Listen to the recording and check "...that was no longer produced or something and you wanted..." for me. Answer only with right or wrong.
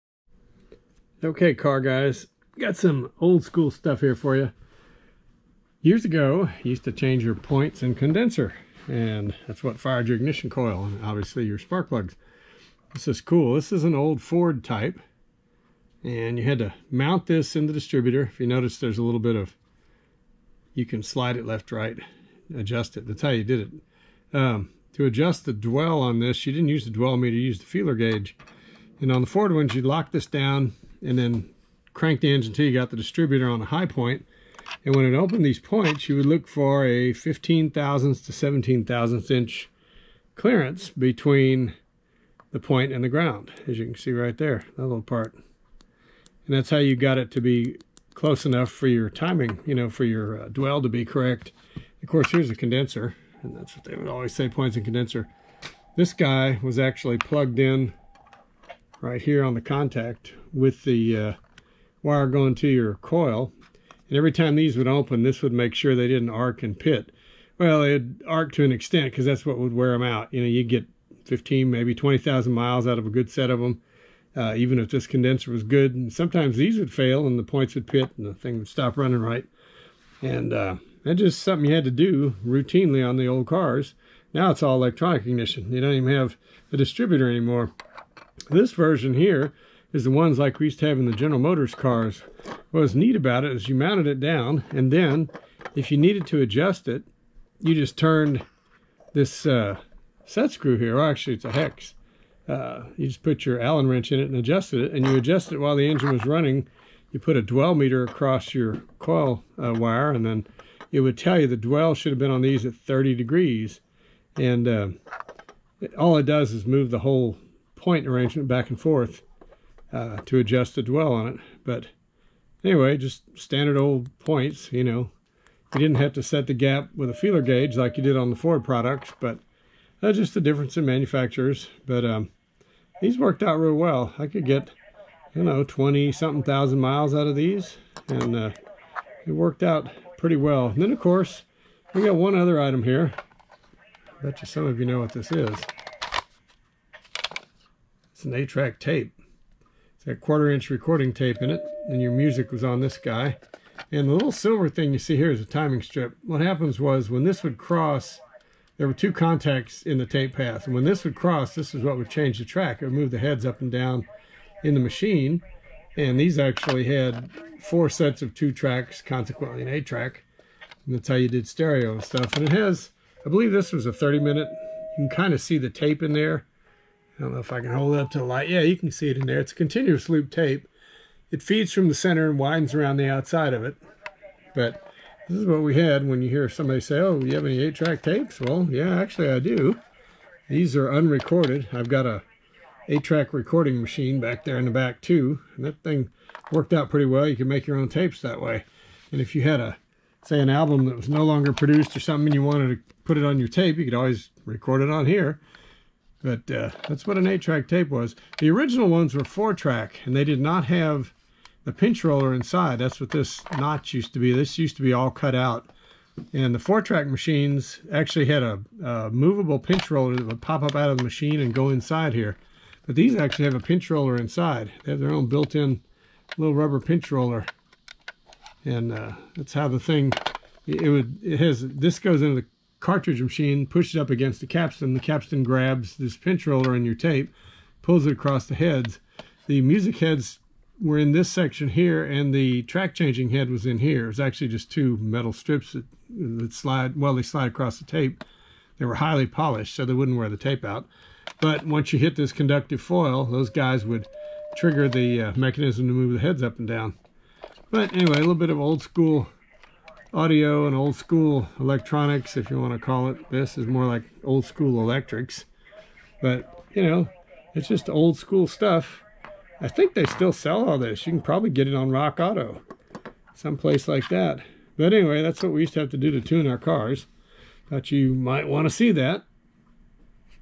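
right.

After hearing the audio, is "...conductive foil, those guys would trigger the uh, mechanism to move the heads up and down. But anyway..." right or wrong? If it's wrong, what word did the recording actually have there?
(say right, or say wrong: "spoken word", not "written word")
right.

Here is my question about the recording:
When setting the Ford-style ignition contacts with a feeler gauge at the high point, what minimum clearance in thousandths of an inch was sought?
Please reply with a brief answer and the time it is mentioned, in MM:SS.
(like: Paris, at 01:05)
15 thousandths, at 00:37.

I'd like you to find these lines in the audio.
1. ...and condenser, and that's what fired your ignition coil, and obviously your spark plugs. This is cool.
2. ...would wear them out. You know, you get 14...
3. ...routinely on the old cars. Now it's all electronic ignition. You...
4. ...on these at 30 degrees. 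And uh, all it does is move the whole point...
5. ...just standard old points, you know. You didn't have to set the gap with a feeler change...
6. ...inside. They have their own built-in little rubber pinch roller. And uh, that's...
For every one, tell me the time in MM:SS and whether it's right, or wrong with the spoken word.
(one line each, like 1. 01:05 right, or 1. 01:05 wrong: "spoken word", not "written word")
1. 00:07 right
2. 01:09 wrong: "15", not "14"
3. 01:22 right
4. 01:52 right
5. 02:02 wrong: "gauge", not "change"
6. 03:44 right.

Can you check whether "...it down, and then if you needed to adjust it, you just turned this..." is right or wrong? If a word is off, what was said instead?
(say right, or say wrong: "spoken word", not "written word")
right.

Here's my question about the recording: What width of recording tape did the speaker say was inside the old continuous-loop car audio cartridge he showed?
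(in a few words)
quarter-inch.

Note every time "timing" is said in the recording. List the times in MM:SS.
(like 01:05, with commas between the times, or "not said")
00:49, 02:35.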